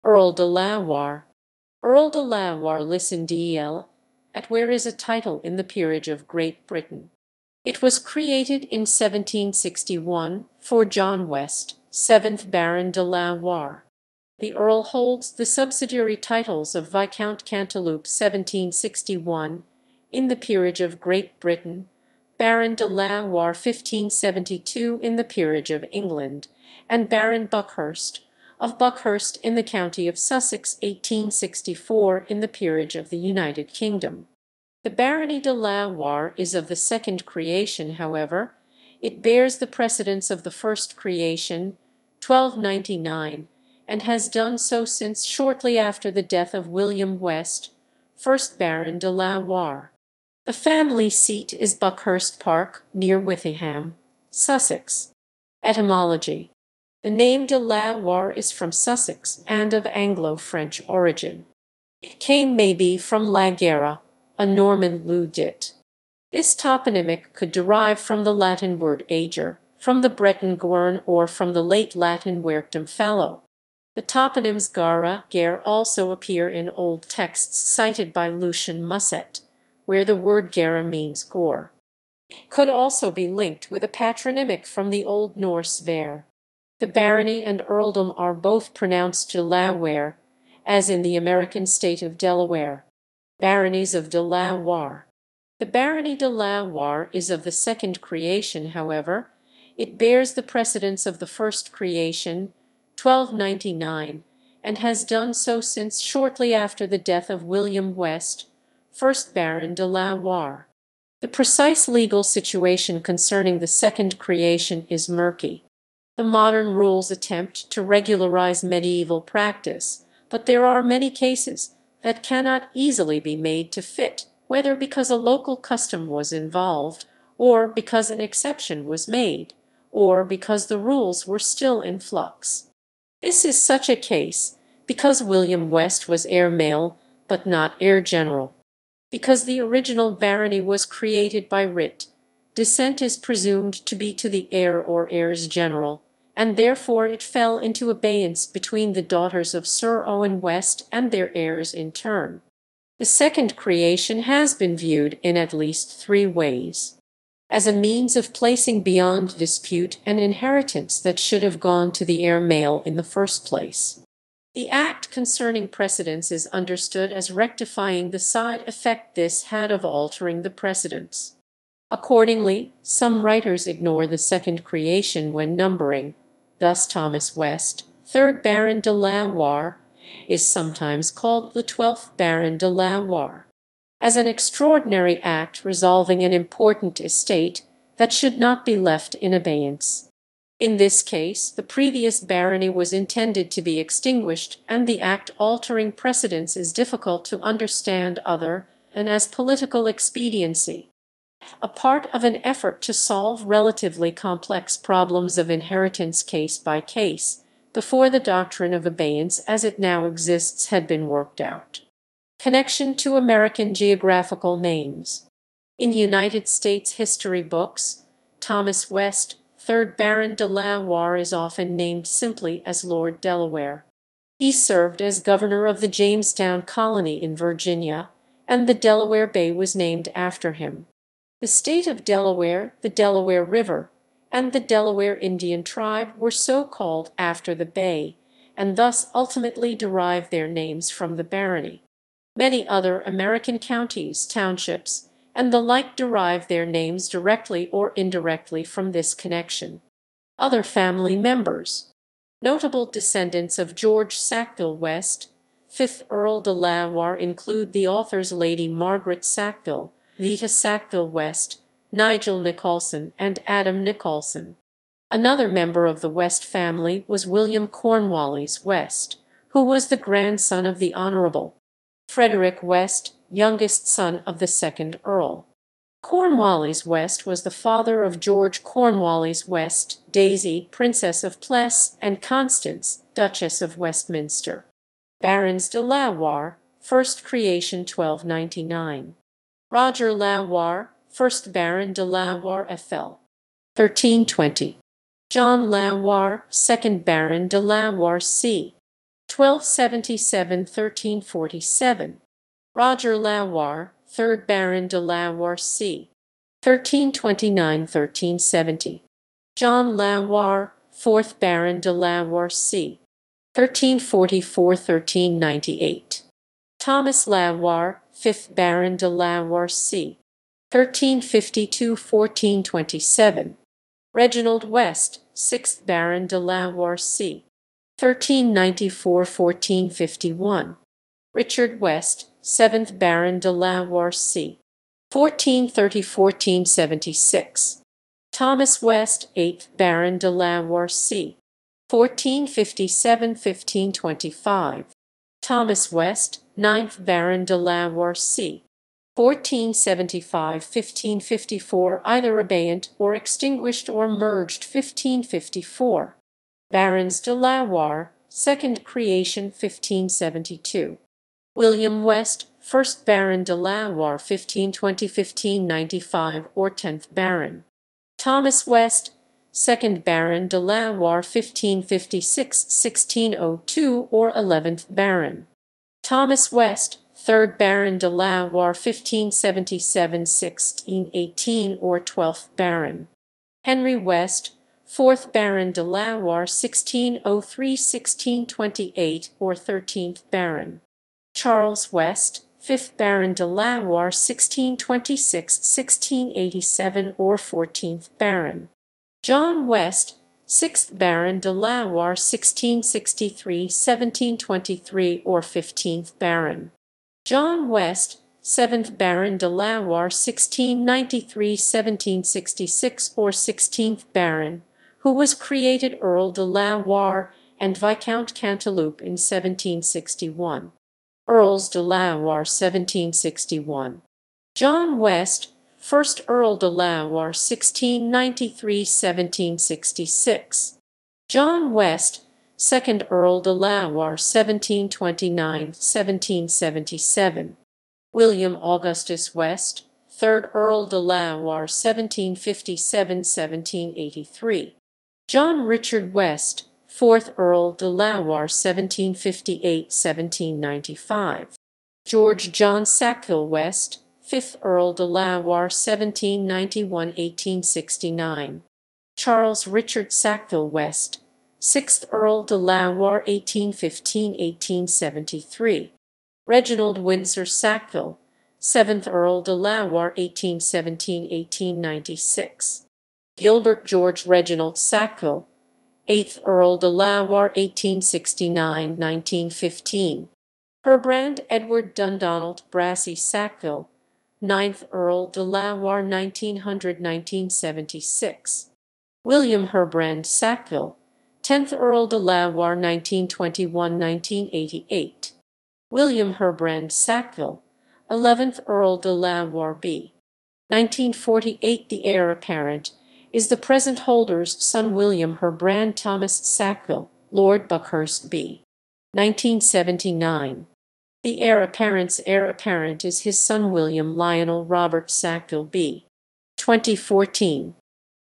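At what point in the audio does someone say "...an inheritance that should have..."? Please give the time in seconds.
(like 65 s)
160 s.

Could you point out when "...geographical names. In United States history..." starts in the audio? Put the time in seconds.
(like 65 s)
213 s.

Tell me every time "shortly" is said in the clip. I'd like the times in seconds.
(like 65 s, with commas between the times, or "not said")
45 s, 105 s.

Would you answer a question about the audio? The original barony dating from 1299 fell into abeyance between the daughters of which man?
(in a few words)
Sir Owen West.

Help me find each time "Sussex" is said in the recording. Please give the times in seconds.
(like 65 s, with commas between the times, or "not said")
30 s, 54 s, 58 s.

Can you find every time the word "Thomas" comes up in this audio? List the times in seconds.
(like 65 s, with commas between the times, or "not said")
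176 s, 218 s, 345 s, 368 s, 505 s.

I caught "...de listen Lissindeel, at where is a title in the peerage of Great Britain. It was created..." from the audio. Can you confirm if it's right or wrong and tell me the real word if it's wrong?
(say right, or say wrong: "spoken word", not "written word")
right.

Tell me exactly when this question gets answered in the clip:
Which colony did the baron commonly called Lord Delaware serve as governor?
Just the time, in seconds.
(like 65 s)
225 s.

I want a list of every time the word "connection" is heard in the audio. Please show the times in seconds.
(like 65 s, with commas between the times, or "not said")
212 s, 249 s.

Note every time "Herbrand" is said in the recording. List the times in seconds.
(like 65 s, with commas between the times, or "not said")
480 s, 489 s, 496 s, 505 s.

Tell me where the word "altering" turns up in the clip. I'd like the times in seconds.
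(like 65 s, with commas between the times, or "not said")
169 s, 195 s.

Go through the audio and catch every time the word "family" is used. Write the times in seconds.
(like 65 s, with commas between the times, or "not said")
50 s, 250 s, 266 s.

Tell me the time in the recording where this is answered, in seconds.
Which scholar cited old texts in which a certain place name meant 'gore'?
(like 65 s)
78 s.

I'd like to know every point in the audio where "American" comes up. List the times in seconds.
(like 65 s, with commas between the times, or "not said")
91 s, 213 s, 243 s.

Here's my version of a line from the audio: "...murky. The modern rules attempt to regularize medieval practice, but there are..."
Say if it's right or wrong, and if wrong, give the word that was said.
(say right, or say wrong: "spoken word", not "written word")
right.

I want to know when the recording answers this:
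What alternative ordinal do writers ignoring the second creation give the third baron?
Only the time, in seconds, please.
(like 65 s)
181 s.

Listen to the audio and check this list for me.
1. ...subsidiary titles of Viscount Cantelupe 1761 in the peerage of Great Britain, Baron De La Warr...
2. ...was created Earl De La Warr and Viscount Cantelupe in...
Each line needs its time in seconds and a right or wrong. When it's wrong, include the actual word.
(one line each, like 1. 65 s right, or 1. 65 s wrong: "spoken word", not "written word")
1. 15 s right
2. 415 s right.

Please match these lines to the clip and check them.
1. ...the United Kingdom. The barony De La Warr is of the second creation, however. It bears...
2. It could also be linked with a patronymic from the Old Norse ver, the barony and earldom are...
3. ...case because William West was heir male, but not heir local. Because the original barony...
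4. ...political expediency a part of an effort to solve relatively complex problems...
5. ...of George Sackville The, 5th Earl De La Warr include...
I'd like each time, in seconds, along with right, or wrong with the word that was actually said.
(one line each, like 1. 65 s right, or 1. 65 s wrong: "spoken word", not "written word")
1. 33 s right
2. 82 s right
3. 133 s wrong: "general", not "local"
4. 199 s right
5. 253 s wrong: "West", not "The".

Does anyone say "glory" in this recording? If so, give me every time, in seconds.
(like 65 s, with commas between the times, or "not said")
not said.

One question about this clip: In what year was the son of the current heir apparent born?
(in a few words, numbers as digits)
2014.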